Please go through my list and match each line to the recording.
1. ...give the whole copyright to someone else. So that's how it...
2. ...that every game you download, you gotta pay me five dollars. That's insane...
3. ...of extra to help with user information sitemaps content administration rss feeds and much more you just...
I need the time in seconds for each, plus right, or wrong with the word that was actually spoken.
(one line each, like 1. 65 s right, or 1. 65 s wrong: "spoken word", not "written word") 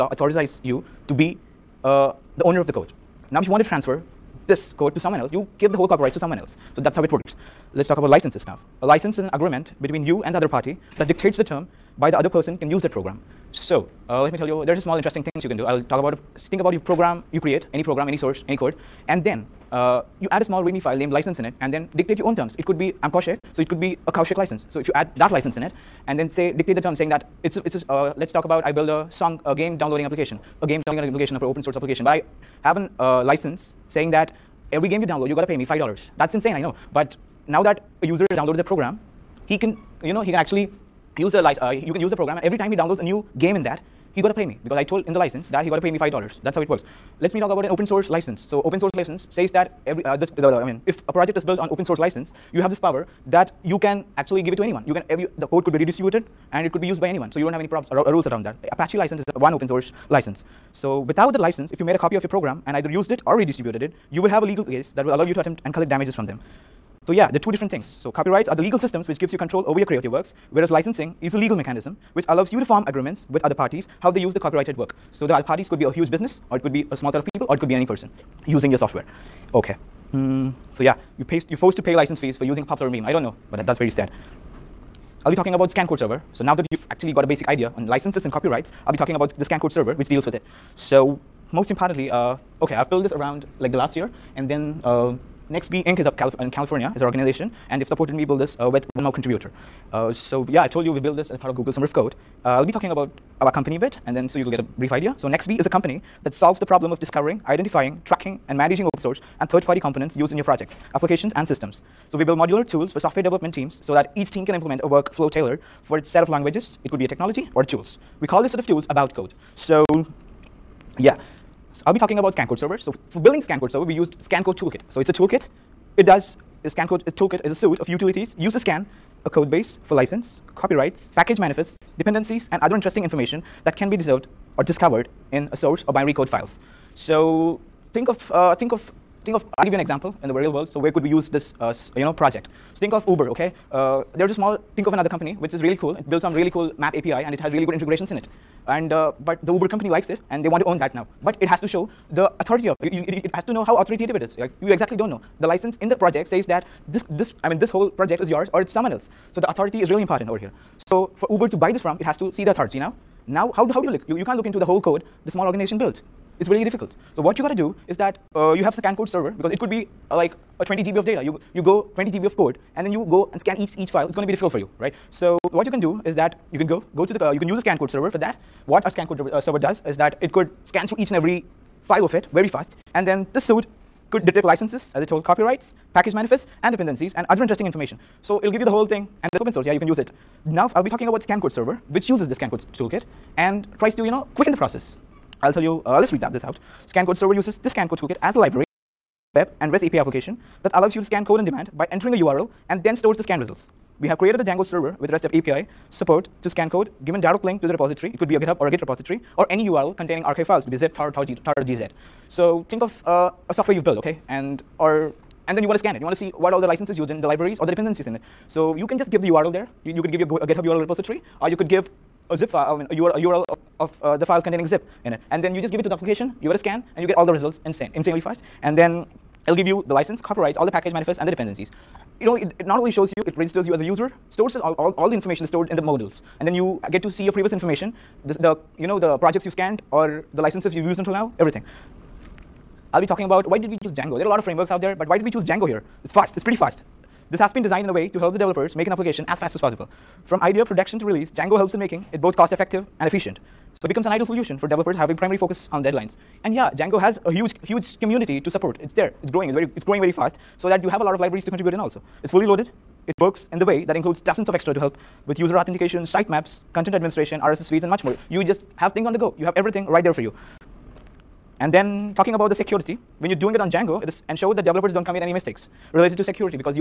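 1. 5 s right
2. 34 s right
3. 264 s wrong: "authentication", not "information".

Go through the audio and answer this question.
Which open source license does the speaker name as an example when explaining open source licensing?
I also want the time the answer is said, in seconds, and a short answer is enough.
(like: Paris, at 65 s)
Apache license, at 58 s.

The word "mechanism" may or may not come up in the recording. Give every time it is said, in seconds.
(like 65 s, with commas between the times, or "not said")
71 s.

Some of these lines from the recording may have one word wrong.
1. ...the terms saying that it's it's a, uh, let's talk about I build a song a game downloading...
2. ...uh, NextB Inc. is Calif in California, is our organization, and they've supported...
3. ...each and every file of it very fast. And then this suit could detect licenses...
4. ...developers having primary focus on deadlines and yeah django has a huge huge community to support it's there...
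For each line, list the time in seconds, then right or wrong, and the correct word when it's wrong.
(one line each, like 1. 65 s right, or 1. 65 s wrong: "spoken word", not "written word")
1. 26 s right
2. 94 s right
3. 180 s right
4. 254 s right.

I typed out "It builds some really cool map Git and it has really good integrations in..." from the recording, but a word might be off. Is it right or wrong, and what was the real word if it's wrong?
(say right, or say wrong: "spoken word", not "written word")
wrong: "API", not "Git".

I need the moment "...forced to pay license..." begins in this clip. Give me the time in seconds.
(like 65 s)
81 s.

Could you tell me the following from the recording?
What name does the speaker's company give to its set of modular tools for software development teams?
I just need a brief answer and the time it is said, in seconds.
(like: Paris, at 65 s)
AboutCode, at 118 s.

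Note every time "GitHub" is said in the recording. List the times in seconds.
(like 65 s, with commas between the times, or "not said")
208 s, 220 s.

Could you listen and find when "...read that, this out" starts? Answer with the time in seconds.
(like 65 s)
196 s.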